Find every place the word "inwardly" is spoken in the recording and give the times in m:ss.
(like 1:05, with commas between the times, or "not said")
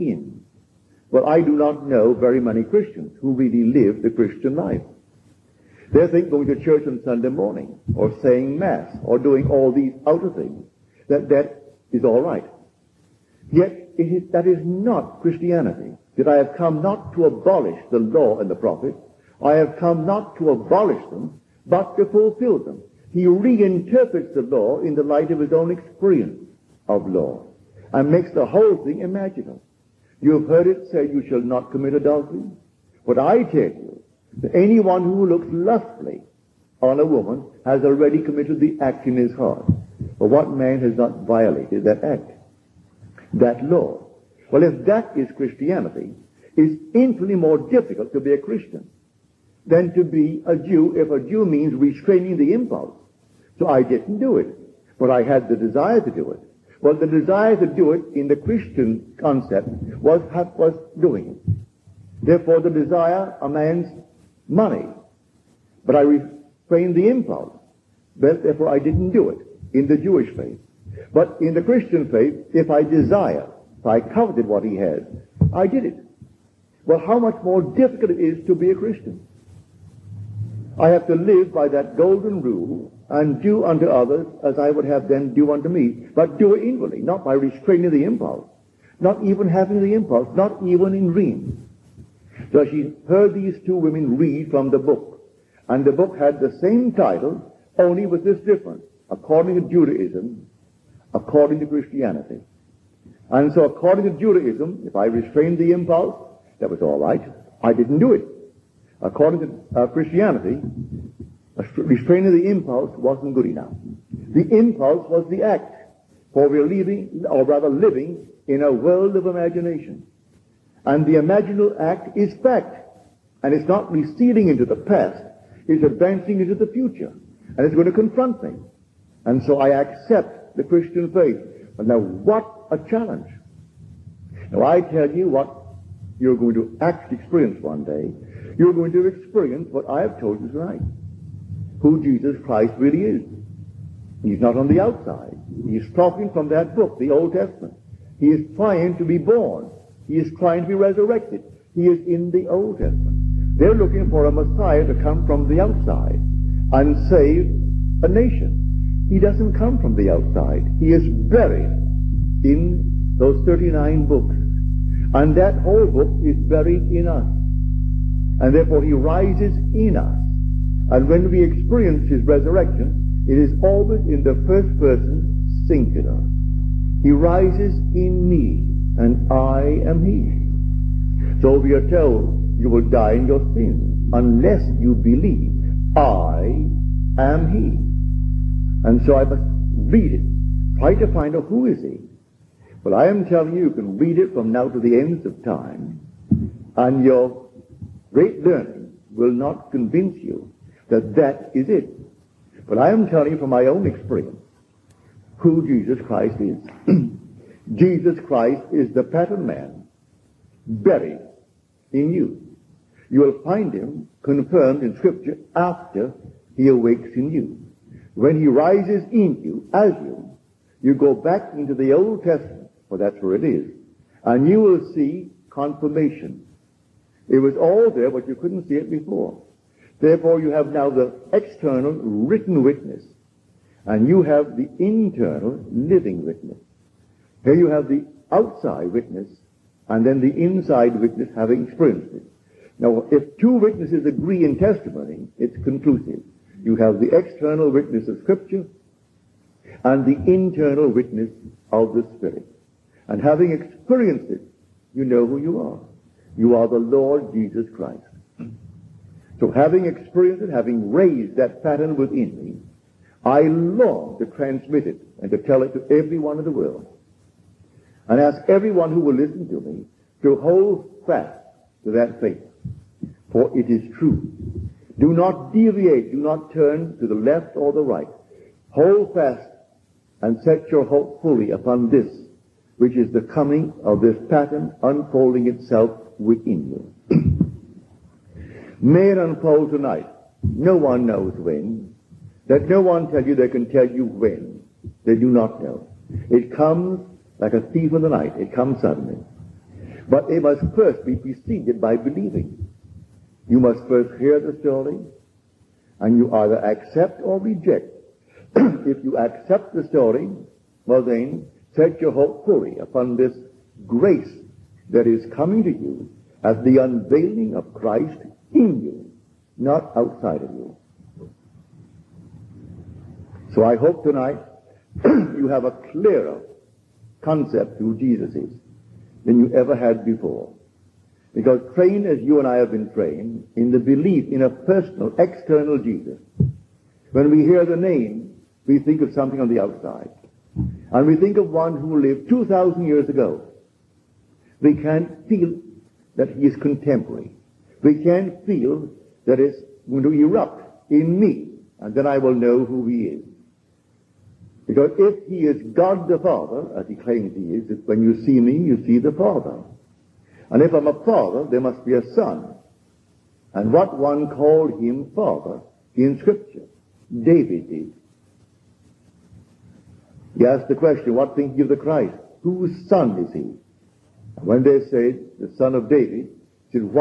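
1:26.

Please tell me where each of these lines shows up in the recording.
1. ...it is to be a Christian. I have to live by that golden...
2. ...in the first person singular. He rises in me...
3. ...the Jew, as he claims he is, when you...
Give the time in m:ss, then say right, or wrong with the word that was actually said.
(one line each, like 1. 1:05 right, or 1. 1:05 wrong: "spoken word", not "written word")
1. 1:18 right
2. 2:54 right
3. 5:56 wrong: "Father", not "Jew".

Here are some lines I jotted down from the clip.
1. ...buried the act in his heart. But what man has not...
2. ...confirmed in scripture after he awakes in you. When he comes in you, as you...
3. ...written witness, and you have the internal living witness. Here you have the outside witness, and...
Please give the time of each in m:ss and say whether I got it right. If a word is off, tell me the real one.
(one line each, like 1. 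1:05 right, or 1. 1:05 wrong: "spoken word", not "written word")
1. 0:38 wrong: "committed", not "buried"
2. 3:34 wrong: "rises", not "comes"
3. 3:51 right.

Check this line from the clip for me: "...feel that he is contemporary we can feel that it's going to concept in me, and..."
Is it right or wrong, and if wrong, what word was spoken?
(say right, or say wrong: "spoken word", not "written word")
wrong: "erupt", not "concept".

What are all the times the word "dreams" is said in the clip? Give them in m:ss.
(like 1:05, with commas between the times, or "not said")
1:31.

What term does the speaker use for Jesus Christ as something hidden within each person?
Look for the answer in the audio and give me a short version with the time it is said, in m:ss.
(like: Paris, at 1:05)
The pattern man, at 3:28.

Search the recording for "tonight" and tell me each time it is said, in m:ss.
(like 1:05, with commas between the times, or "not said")
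2:20, 4:49, 5:24.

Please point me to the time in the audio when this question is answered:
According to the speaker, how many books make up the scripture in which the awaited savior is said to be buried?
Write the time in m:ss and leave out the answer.
2:43.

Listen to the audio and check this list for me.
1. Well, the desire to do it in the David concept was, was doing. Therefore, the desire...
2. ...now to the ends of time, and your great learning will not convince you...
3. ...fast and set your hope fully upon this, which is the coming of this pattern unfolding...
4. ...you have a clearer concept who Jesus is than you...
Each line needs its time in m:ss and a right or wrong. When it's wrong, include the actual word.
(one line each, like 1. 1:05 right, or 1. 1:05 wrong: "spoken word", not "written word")
1. 0:56 wrong: "Christian", not "David"
2. 3:14 right
3. 4:39 right
4. 5:25 right.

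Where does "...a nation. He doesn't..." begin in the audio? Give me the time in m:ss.
2:38.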